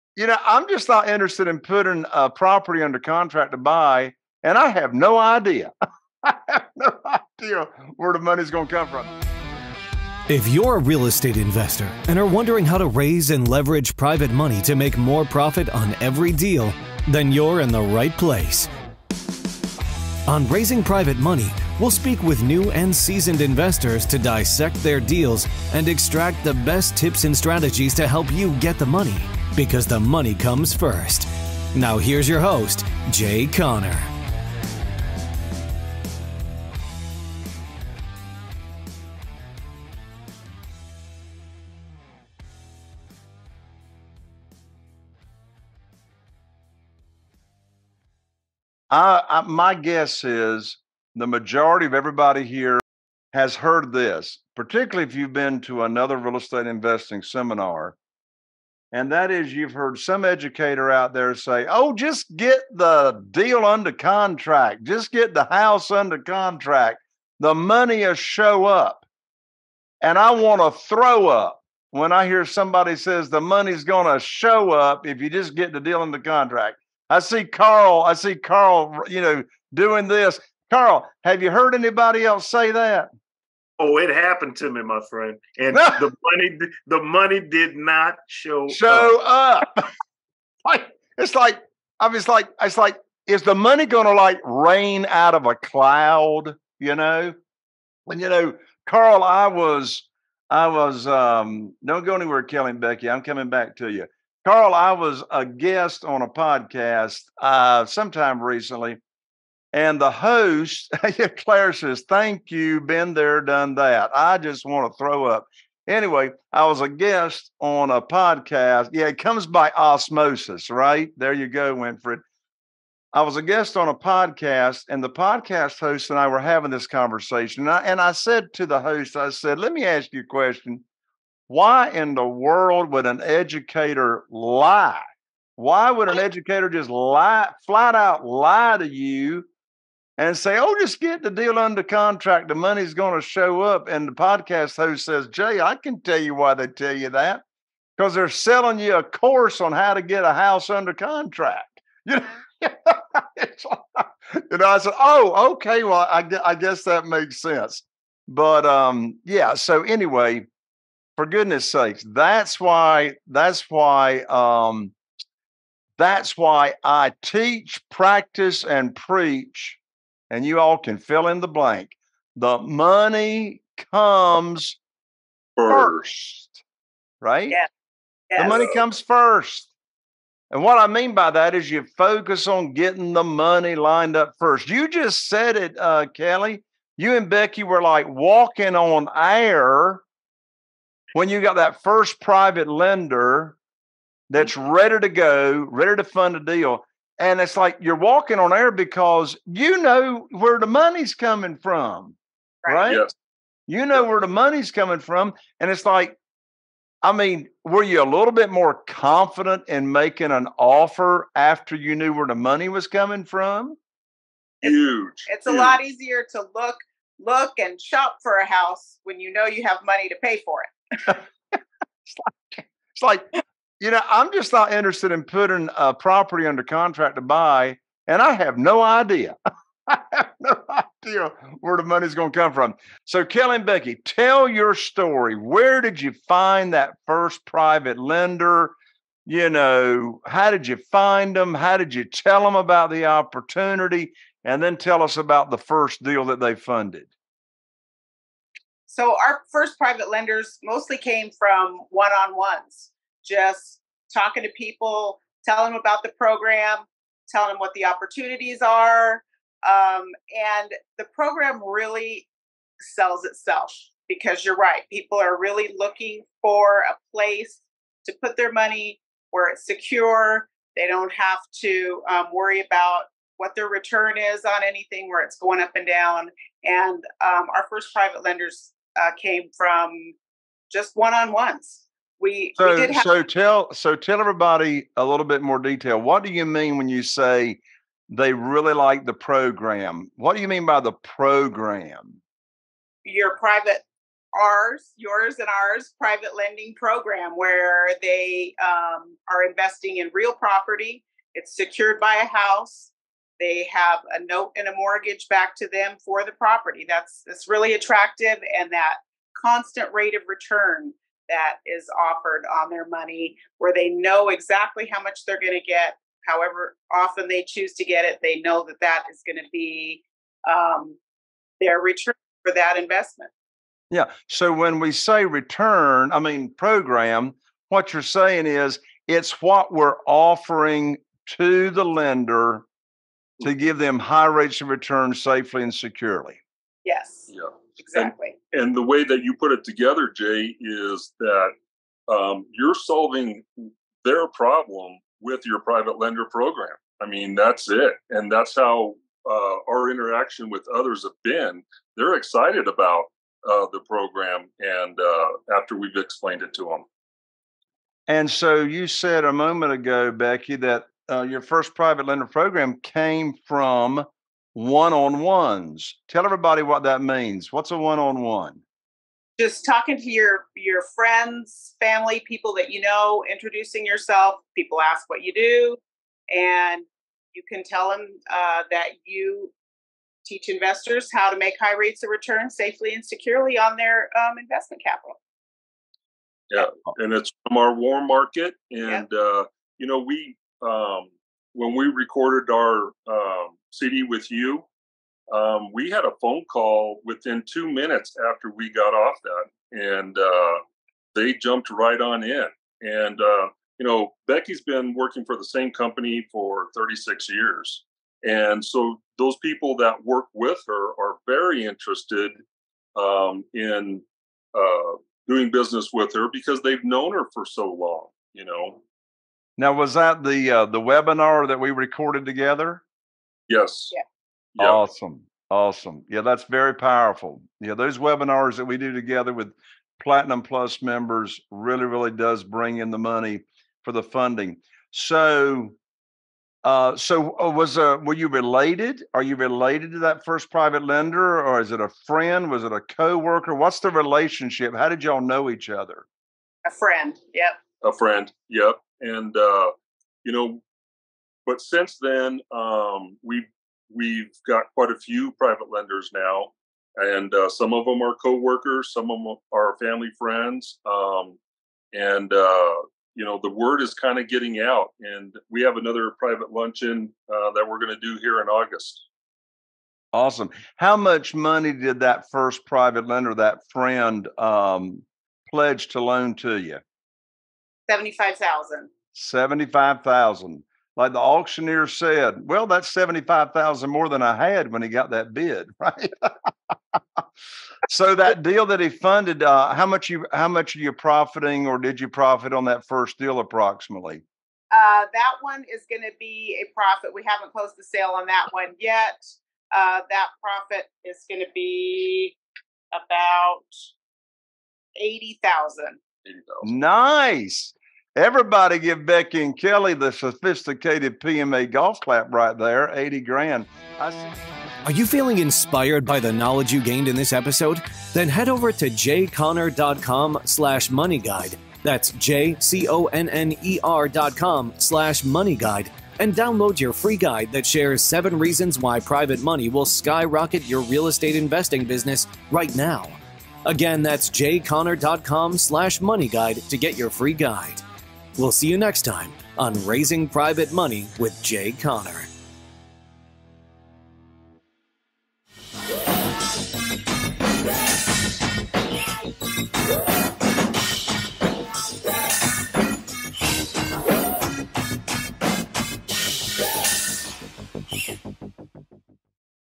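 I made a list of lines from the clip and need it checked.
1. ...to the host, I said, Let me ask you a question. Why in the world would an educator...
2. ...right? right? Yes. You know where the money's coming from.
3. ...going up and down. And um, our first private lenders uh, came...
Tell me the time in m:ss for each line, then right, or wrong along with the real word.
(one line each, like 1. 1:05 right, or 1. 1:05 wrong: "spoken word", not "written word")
1. 2:08 right
2. 3:22 right
3. 4:35 right.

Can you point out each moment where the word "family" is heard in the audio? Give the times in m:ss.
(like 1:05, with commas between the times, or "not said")
6:11, 7:39.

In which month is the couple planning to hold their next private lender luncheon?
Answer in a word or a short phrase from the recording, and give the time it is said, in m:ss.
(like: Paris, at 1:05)
August, at 7:48.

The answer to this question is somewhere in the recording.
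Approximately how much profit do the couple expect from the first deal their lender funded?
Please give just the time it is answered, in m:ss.
8:22.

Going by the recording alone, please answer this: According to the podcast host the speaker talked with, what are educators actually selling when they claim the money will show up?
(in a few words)
a course.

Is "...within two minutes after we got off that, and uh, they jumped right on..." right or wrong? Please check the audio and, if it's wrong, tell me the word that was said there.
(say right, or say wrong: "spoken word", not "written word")
right.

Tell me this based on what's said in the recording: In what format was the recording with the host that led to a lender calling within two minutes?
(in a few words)
webinar.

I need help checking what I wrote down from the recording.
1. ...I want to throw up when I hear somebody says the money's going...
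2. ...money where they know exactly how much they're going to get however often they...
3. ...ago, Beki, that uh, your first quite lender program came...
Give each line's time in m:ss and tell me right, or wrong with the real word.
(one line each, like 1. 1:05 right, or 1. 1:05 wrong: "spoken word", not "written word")
1. 1:10 right
2. 5:12 right
3. 5:59 wrong: "private", not "quite".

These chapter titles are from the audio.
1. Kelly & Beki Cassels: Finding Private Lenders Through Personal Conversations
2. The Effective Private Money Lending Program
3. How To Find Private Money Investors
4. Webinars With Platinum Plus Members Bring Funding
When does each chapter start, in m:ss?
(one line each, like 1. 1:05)
1. 3:53
2. 4:50
3. 5:57
4. 7:04.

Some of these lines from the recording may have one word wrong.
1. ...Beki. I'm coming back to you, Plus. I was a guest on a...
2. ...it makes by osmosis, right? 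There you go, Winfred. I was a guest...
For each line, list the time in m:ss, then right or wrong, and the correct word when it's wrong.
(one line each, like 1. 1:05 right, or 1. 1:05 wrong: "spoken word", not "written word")
1. 1:42 wrong: "Carl", not "Plus"
2. 1:59 wrong: "comes", not "makes".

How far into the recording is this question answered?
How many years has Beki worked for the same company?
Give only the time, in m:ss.
6:46.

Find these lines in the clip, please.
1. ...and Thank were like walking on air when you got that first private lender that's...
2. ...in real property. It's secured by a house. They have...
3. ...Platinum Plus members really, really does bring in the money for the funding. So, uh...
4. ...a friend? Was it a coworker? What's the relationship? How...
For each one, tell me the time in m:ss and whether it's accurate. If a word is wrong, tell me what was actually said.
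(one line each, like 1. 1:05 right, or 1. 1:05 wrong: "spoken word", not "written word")
1. 3:07 wrong: "Beki", not "Thank"
2. 4:59 right
3. 7:10 right
4. 7:21 right.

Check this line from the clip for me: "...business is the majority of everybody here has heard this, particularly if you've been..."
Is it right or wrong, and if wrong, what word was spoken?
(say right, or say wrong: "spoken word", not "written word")
wrong: "guess", not "business".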